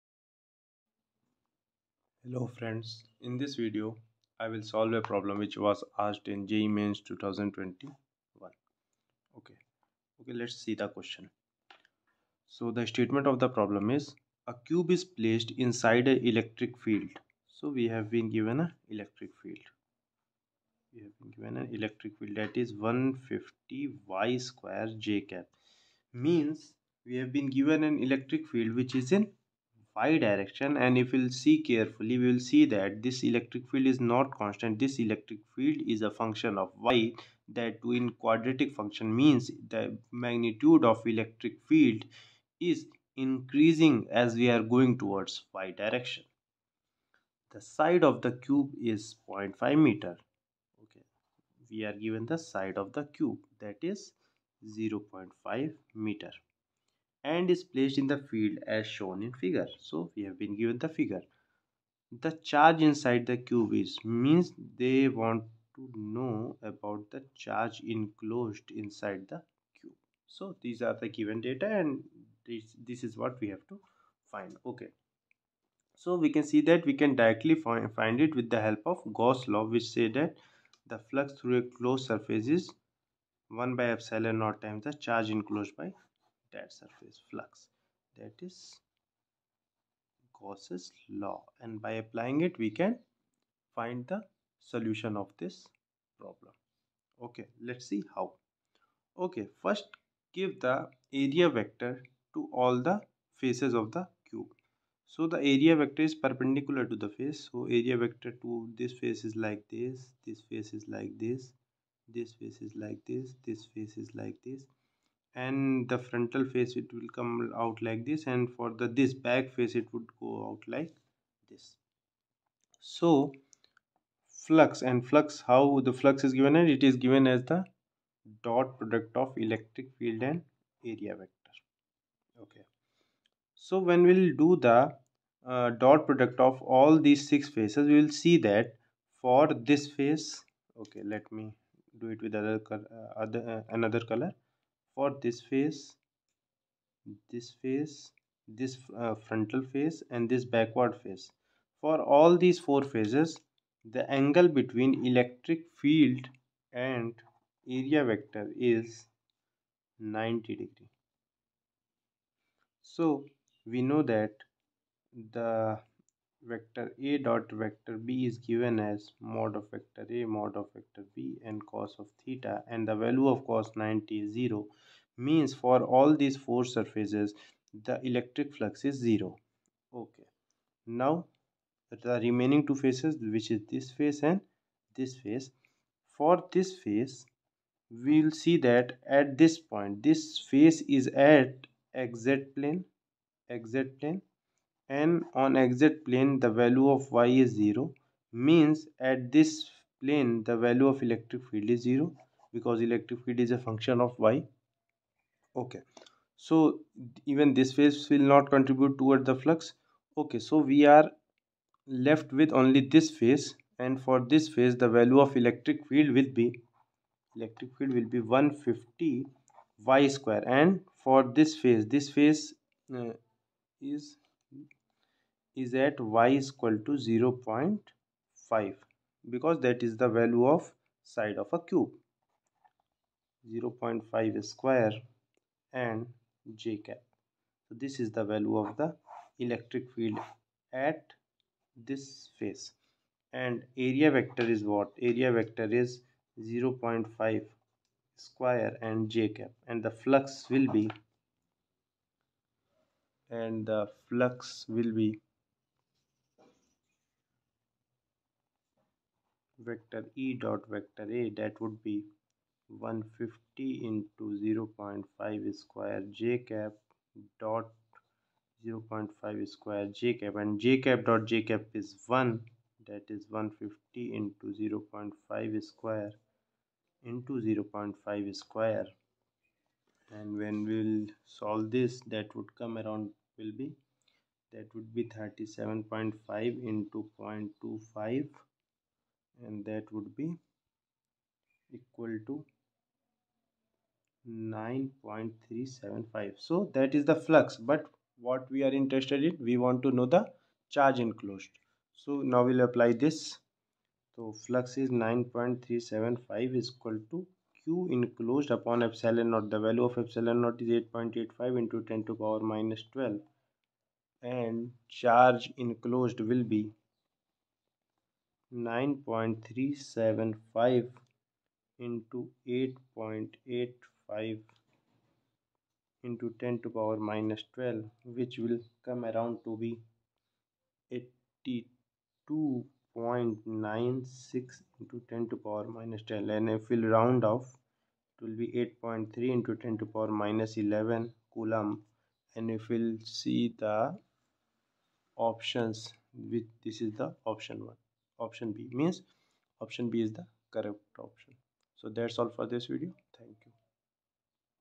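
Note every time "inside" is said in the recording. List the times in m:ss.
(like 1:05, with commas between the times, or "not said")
0:15, 1:02, 1:08.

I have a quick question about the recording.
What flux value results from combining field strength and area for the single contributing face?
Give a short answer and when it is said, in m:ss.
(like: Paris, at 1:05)
9.375, at 4:49.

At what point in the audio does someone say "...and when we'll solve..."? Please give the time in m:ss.
4:40.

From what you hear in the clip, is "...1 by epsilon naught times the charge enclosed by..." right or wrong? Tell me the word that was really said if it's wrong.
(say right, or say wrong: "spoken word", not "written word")
right.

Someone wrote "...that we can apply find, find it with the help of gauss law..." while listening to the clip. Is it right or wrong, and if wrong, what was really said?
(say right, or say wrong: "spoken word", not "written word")
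wrong: "directly", not "apply".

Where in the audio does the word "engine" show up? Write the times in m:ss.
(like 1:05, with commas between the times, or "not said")
not said.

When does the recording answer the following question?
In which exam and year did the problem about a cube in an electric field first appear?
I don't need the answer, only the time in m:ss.
0:06.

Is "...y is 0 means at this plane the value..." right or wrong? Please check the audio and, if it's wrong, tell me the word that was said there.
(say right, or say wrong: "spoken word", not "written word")
right.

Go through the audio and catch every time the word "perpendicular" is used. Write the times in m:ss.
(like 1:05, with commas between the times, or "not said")
1:46.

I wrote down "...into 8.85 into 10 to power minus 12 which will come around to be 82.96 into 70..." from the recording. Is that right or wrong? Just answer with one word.
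wrong.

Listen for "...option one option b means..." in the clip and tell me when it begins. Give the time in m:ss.
5:47.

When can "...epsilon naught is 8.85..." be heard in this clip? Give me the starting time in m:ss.
5:10.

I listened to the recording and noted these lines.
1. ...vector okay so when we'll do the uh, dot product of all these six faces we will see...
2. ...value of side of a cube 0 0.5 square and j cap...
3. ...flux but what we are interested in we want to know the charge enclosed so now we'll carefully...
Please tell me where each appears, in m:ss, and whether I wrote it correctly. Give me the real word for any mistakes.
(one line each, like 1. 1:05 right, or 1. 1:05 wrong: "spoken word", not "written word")
1. 2:11 right
2. 3:50 right
3. 4:57 wrong: "apply", not "carefully".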